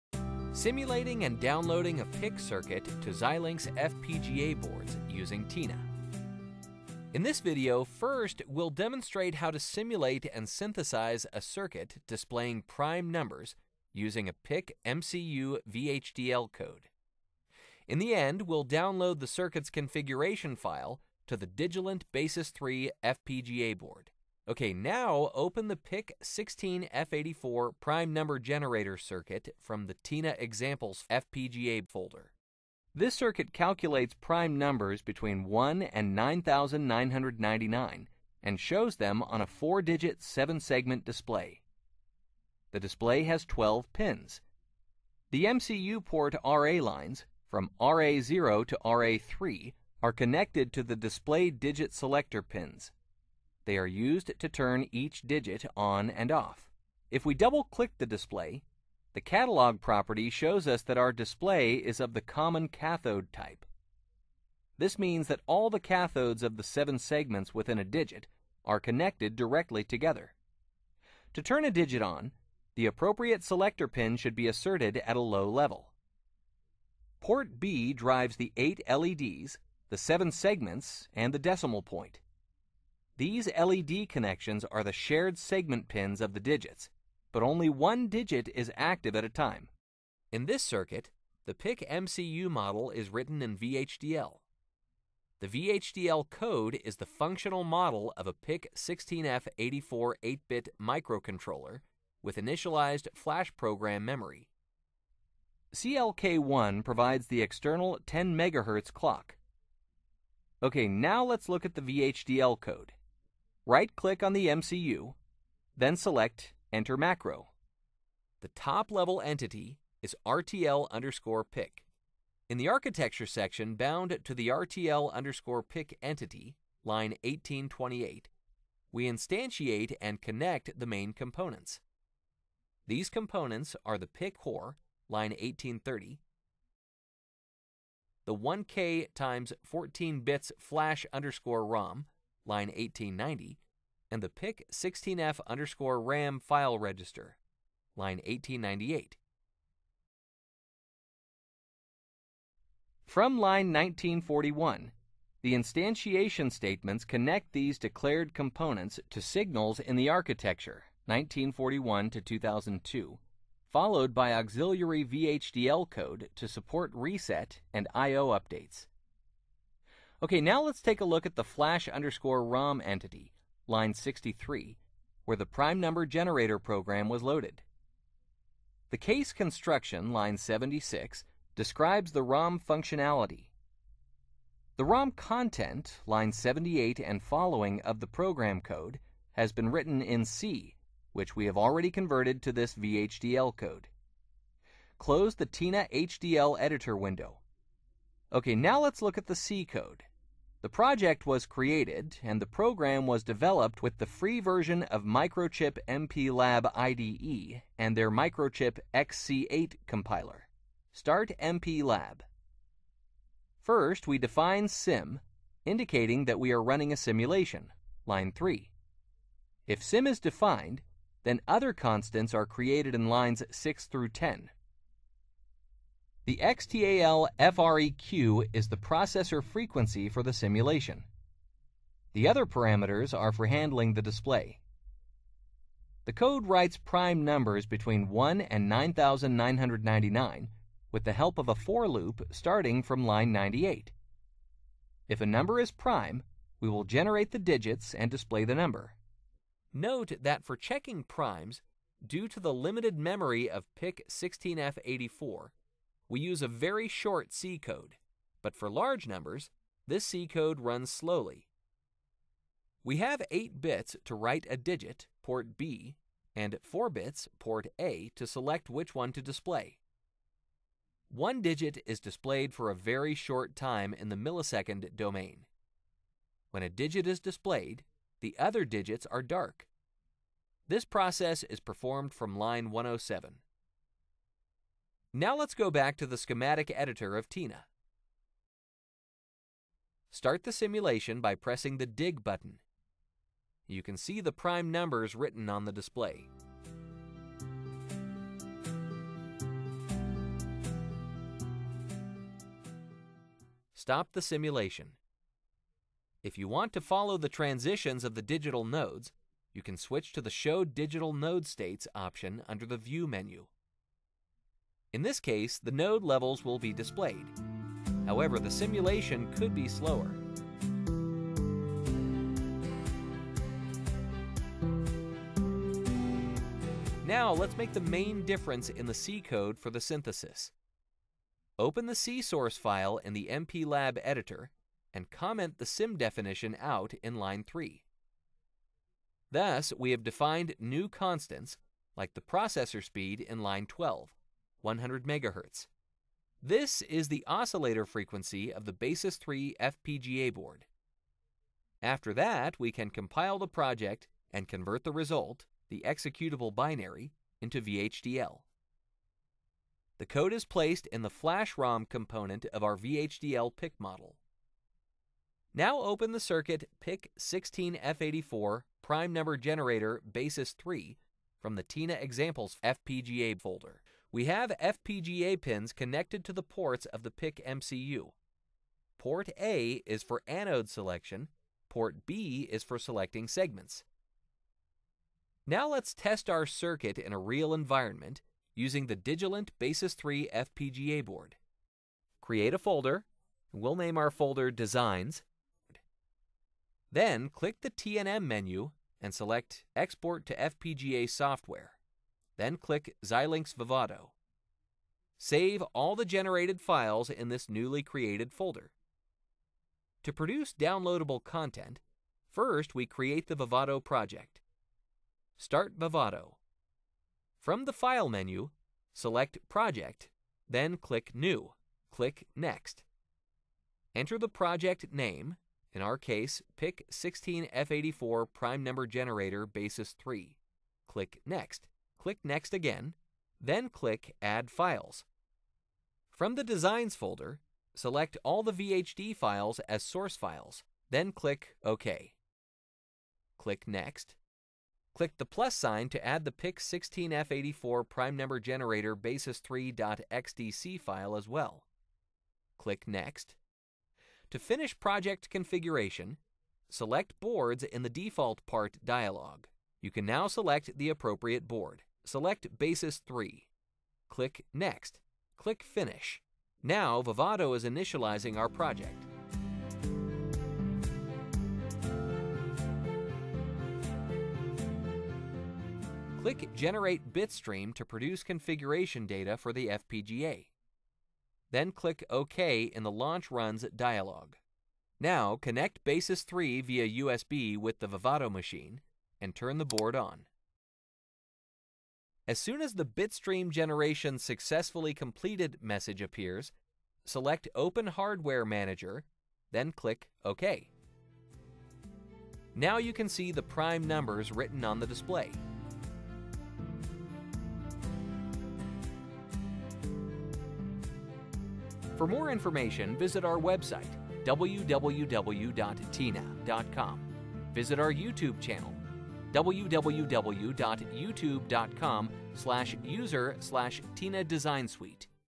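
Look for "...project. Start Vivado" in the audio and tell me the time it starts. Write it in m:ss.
6:53.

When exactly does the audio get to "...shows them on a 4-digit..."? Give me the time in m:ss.
0:38.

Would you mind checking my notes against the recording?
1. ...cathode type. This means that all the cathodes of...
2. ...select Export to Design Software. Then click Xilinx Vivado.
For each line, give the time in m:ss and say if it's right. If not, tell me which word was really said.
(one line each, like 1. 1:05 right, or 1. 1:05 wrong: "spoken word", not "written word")
1. 1:02 right
2. 6:39 wrong: "FPGA", not "Design".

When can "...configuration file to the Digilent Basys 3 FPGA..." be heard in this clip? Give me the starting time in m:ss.
0:19.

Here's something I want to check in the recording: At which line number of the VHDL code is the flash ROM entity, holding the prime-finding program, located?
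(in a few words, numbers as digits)
63.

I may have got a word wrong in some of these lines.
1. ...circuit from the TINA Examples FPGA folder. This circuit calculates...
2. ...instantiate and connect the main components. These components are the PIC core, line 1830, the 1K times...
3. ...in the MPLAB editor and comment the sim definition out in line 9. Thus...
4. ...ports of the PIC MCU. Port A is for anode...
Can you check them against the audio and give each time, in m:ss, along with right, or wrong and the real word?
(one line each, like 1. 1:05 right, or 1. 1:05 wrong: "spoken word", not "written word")
1. 0:28 right
2. 2:09 right
3. 5:32 wrong: "3", not "9"
4. 6:16 right.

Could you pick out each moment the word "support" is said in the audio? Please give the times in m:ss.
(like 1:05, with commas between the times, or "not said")
2:46.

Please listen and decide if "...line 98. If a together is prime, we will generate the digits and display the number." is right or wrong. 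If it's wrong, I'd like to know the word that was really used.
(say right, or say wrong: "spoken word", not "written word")
wrong: "number", not "together".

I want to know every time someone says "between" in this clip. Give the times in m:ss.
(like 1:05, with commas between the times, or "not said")
0:35, 3:57.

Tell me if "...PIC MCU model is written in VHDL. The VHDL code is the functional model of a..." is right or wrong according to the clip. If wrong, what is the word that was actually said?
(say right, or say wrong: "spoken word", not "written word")
right.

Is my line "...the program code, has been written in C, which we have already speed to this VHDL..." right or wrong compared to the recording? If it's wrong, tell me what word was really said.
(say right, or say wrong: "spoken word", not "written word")
wrong: "converted", not "speed".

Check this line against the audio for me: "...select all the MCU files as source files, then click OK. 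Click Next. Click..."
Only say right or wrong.
wrong.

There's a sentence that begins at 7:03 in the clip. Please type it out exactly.
Enter the project name, in our case, PIC 16F84 prime number generator Basys 3.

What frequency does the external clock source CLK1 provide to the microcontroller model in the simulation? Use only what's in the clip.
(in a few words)
10 MHz.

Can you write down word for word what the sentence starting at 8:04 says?
Now connect Basys 3 via USB with the Vivado machine and turn the board on.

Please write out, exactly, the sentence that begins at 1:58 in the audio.
The top-level entity is RTL underscore PIC.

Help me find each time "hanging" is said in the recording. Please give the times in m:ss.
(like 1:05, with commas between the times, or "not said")
not said.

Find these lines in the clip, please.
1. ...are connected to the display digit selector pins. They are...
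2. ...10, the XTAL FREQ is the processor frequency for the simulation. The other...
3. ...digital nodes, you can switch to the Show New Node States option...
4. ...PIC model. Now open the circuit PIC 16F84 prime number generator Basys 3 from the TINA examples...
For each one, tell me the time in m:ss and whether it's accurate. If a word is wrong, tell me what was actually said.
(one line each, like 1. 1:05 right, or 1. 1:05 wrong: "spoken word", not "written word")
1. 0:50 right
2. 3:44 right
3. 5:08 wrong: "Digital", not "New"
4. 6:03 right.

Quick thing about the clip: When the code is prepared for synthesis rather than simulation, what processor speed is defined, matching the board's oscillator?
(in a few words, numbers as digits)
100 MHz.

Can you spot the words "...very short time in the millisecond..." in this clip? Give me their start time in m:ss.
4:32.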